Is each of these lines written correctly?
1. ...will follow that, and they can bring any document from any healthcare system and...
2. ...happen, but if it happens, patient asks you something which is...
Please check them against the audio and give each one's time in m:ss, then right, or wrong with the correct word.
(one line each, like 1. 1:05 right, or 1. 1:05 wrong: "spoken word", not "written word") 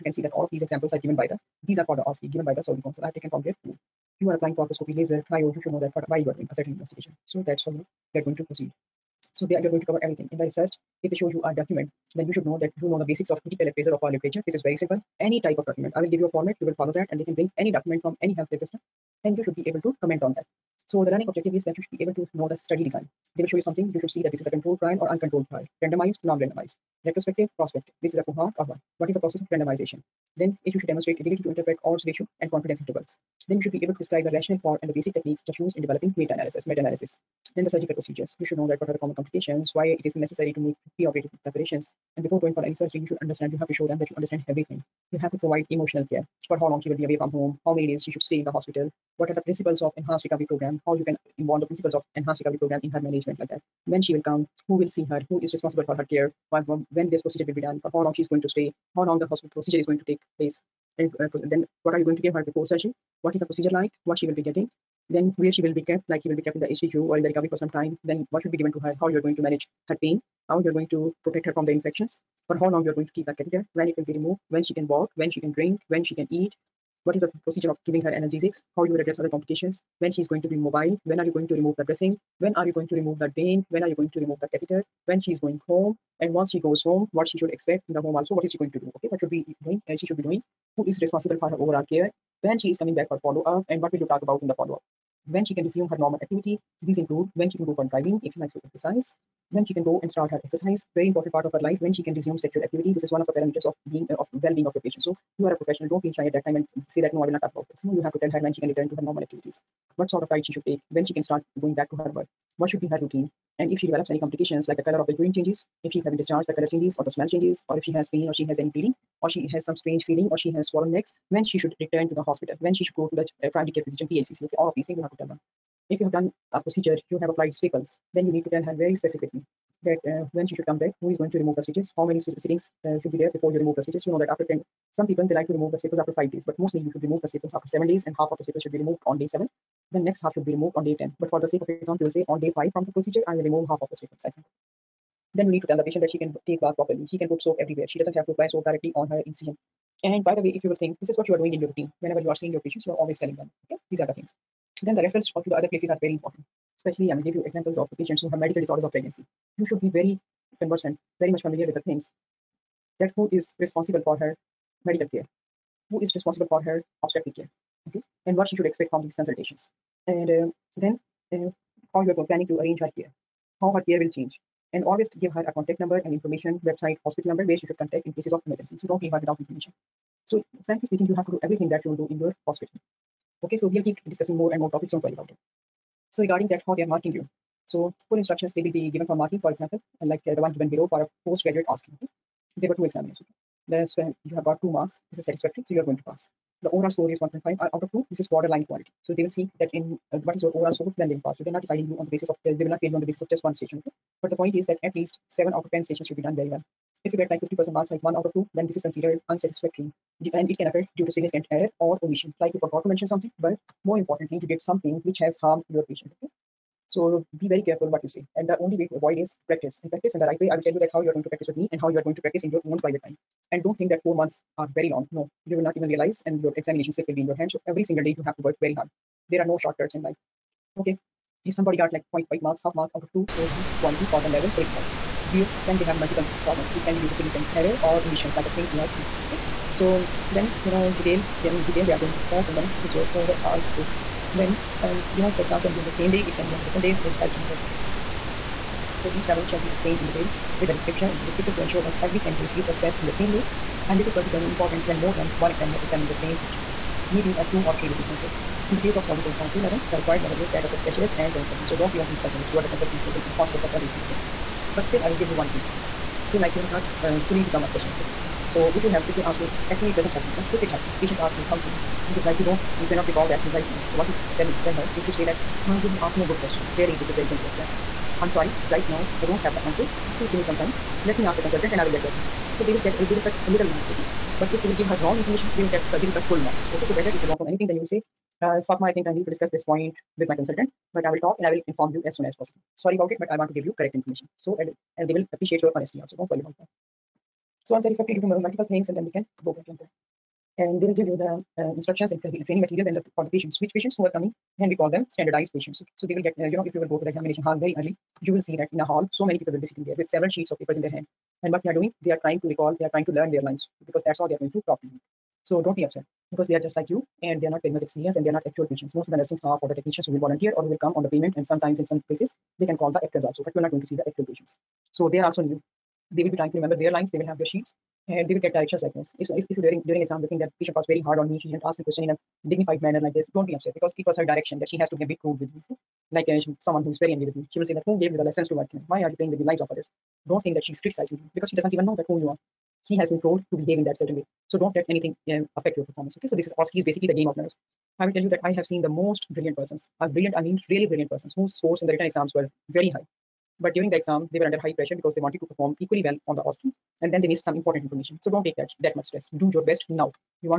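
1. 0:16 right
2. 4:30 right.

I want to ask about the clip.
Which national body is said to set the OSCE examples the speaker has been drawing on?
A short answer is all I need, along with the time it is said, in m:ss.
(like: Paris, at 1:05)
Saudi Council, at 0:02.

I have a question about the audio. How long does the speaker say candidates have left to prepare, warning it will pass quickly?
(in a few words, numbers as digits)
4 months.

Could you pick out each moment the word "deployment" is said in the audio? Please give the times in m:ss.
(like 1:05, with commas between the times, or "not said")
not said.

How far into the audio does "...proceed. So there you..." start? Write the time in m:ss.
0:08.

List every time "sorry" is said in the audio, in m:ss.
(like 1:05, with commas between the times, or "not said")
4:38, 4:52.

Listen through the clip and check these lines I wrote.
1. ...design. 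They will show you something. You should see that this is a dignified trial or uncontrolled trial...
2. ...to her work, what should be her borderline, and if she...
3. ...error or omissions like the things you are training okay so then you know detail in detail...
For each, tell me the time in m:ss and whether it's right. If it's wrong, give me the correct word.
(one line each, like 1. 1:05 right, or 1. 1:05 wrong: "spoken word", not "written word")
1. 0:22 wrong: "controlled", not "dignified"
2. 1:51 wrong: "routine", not "borderline"
3. 3:57 wrong: "missing", not "training".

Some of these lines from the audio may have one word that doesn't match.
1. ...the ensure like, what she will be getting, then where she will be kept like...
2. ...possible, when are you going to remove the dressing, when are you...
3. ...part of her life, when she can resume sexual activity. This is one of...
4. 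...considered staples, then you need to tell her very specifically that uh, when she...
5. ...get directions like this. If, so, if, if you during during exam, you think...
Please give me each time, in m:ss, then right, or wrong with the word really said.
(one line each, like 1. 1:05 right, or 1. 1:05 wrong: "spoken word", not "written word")
1. 1:03 wrong: "procedure", not "ensure"
2. 1:20 wrong: "mobile", not "possible"
3. 1:41 right
4. 2:07 wrong: "applied", not "considered"
5. 5:28 right.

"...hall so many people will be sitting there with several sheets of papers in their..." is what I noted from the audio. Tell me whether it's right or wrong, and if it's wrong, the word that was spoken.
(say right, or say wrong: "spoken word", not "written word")
right.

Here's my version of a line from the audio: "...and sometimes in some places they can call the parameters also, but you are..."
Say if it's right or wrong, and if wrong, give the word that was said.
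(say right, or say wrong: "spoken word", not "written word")
wrong: "actors", not "parameters".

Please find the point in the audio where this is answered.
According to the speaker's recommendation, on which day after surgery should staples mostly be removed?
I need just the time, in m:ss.
2:17.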